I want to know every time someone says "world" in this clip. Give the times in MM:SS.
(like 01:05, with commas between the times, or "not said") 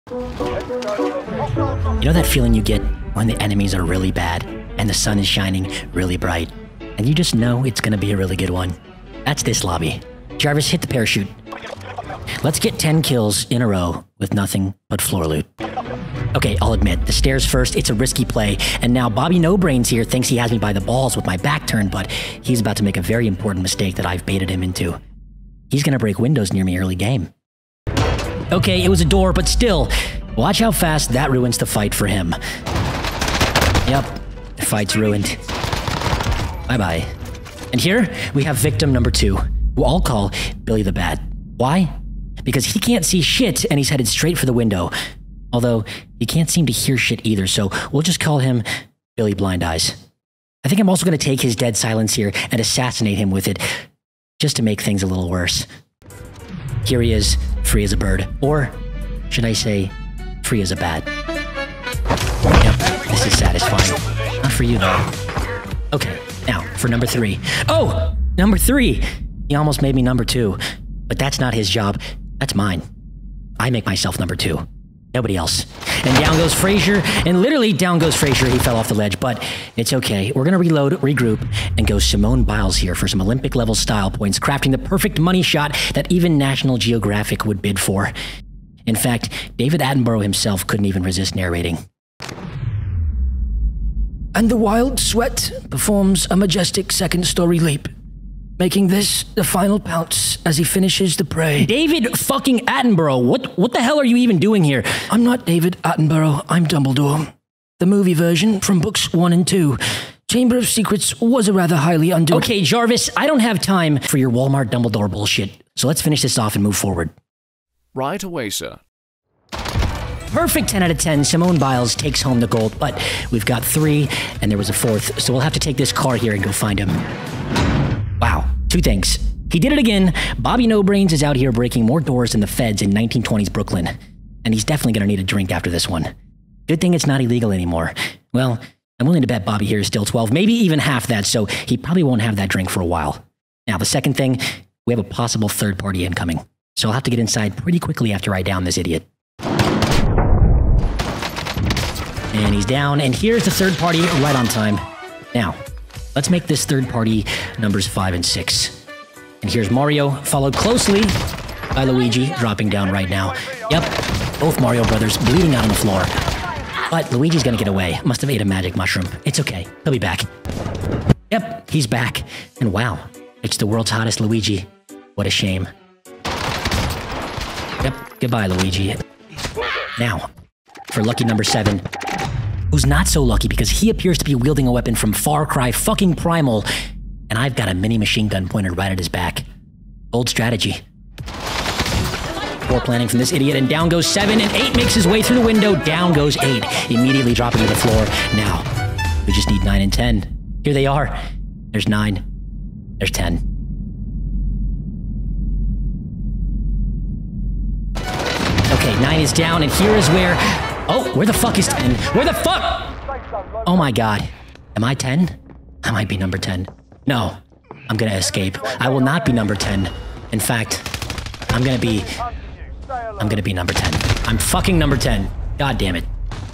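02:53.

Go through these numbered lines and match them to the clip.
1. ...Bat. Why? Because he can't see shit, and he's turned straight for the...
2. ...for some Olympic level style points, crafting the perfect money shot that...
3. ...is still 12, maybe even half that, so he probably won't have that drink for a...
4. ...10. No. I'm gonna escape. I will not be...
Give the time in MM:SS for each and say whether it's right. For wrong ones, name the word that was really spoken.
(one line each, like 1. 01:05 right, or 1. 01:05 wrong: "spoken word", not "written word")
1. 00:40 wrong: "headed", not "turned"
2. 01:22 right
3. 02:19 right
4. 03:36 right.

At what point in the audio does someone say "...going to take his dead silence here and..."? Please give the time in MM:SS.
00:51.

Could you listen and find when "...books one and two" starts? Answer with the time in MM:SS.
01:48.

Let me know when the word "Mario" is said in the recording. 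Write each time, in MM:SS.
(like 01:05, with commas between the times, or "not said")
02:39, 02:44.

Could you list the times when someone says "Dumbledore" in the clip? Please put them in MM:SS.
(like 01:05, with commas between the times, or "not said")
01:46, 01:54.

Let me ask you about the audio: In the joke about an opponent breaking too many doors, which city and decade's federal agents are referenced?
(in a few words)
1920s Brooklyn.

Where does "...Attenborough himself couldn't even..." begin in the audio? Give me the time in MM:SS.
01:29.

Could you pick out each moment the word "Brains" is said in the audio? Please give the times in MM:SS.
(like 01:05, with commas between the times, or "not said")
00:19, 02:10.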